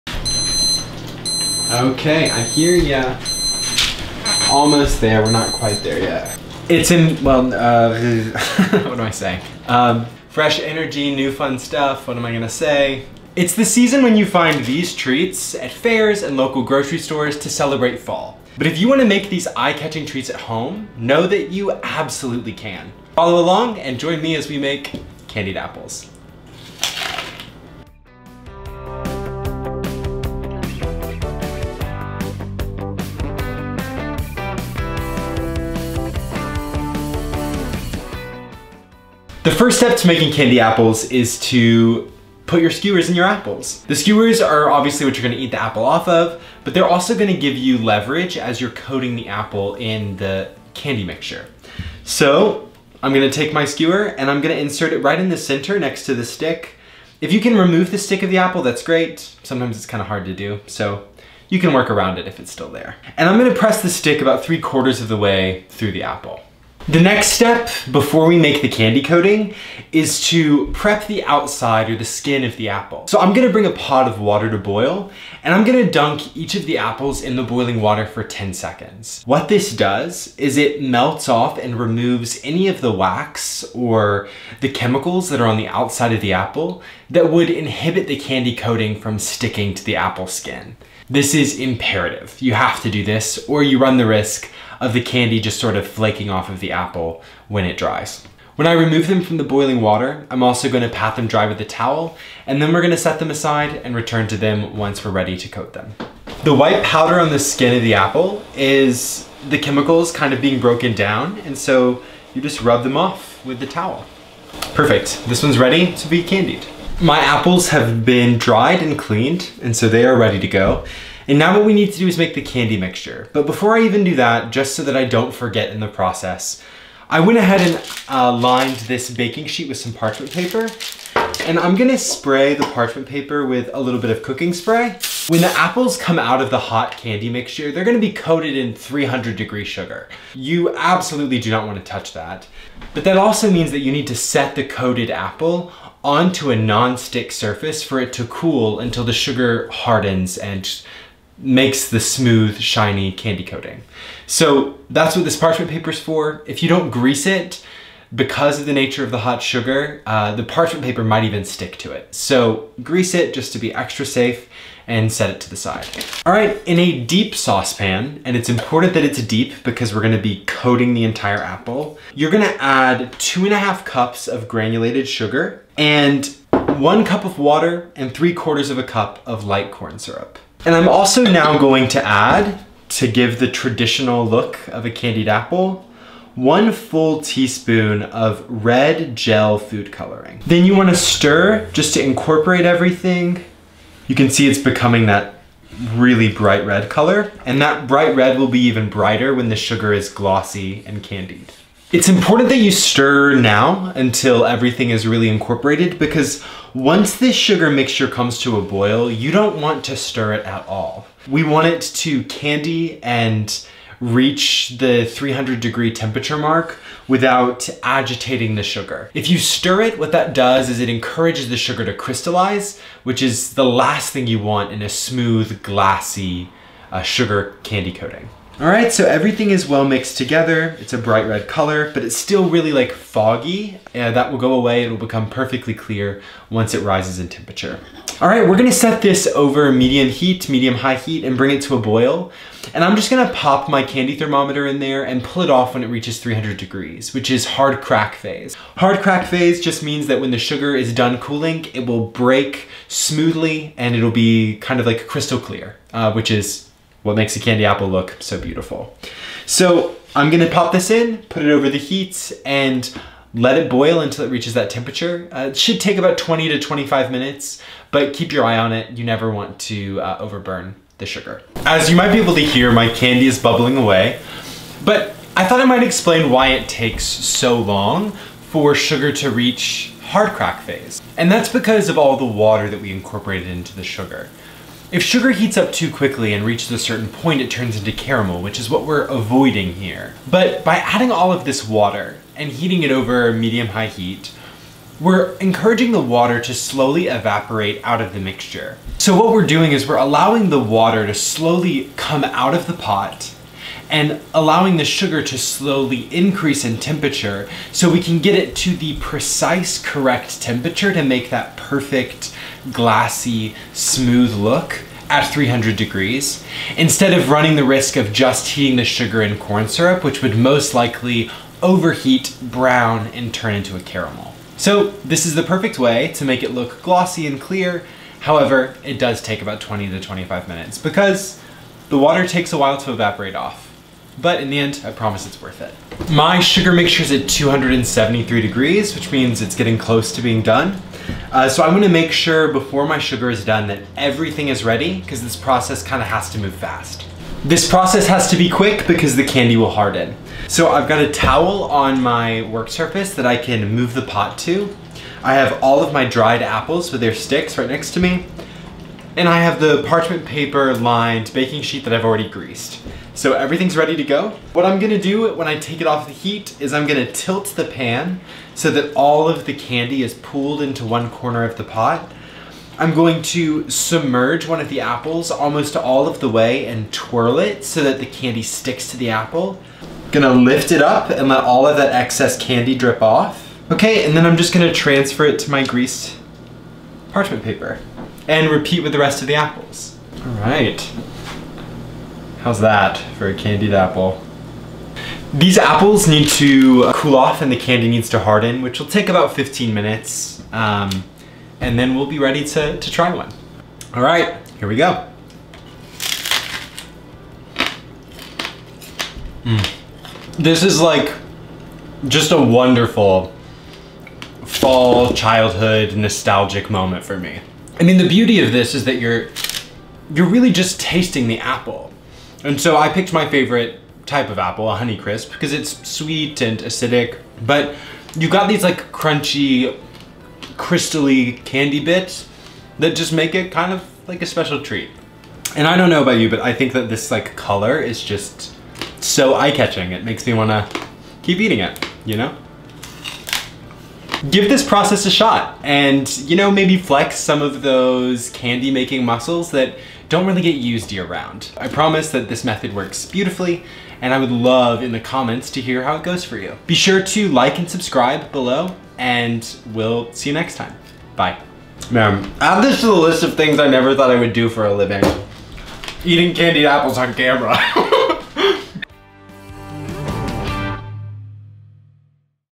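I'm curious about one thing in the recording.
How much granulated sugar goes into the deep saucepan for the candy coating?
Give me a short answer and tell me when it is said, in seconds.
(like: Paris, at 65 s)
2 and a half cups, at 173 s.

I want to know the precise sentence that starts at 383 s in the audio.
Okay, and then I'm just gonna transfer it to my greased parchment paper and repeat with the rest of the apples.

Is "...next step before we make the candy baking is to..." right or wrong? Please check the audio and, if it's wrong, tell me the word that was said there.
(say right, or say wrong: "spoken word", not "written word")
wrong: "coating", not "baking".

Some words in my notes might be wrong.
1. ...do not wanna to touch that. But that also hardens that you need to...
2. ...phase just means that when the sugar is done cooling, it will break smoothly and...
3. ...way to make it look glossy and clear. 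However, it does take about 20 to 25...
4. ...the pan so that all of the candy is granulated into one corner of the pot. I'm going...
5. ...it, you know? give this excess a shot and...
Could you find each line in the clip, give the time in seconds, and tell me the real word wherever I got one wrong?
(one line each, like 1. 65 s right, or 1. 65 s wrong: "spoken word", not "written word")
1. 141 s wrong: "means", not "hardens"
2. 249 s right
3. 325 s right
4. 367 s wrong: "pooled", not "granulated"
5. 441 s wrong: "process", not "excess".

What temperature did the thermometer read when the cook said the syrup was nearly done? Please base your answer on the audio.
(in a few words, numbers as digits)
273 degrees.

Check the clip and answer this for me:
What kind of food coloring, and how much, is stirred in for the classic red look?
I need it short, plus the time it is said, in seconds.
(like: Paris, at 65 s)
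1 teaspoon red gel, at 186 s.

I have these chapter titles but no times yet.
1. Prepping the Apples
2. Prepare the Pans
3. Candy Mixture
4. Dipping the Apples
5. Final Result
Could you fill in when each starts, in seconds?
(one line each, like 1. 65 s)
1. 40 s
2. 117 s
3. 166 s
4. 365 s
5. 396 s.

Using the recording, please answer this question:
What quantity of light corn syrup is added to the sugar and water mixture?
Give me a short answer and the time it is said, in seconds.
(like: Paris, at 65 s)
3/4 of a cup, at 178 s.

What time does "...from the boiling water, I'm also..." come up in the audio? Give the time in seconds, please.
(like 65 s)
99 s.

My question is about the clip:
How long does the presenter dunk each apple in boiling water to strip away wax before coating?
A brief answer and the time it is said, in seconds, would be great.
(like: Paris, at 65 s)
10 seconds, at 78 s.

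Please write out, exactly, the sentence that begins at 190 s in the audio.
Then you wanna stir just to incorporate everything.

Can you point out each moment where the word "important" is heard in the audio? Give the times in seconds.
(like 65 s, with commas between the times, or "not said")
168 s, 202 s.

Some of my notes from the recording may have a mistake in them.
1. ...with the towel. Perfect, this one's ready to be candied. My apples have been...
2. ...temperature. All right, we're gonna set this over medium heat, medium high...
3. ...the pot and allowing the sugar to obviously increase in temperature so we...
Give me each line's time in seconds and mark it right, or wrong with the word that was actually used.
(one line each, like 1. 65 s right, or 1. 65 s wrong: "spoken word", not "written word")
1. 113 s right
2. 237 s right
3. 302 s wrong: "slowly", not "obviously".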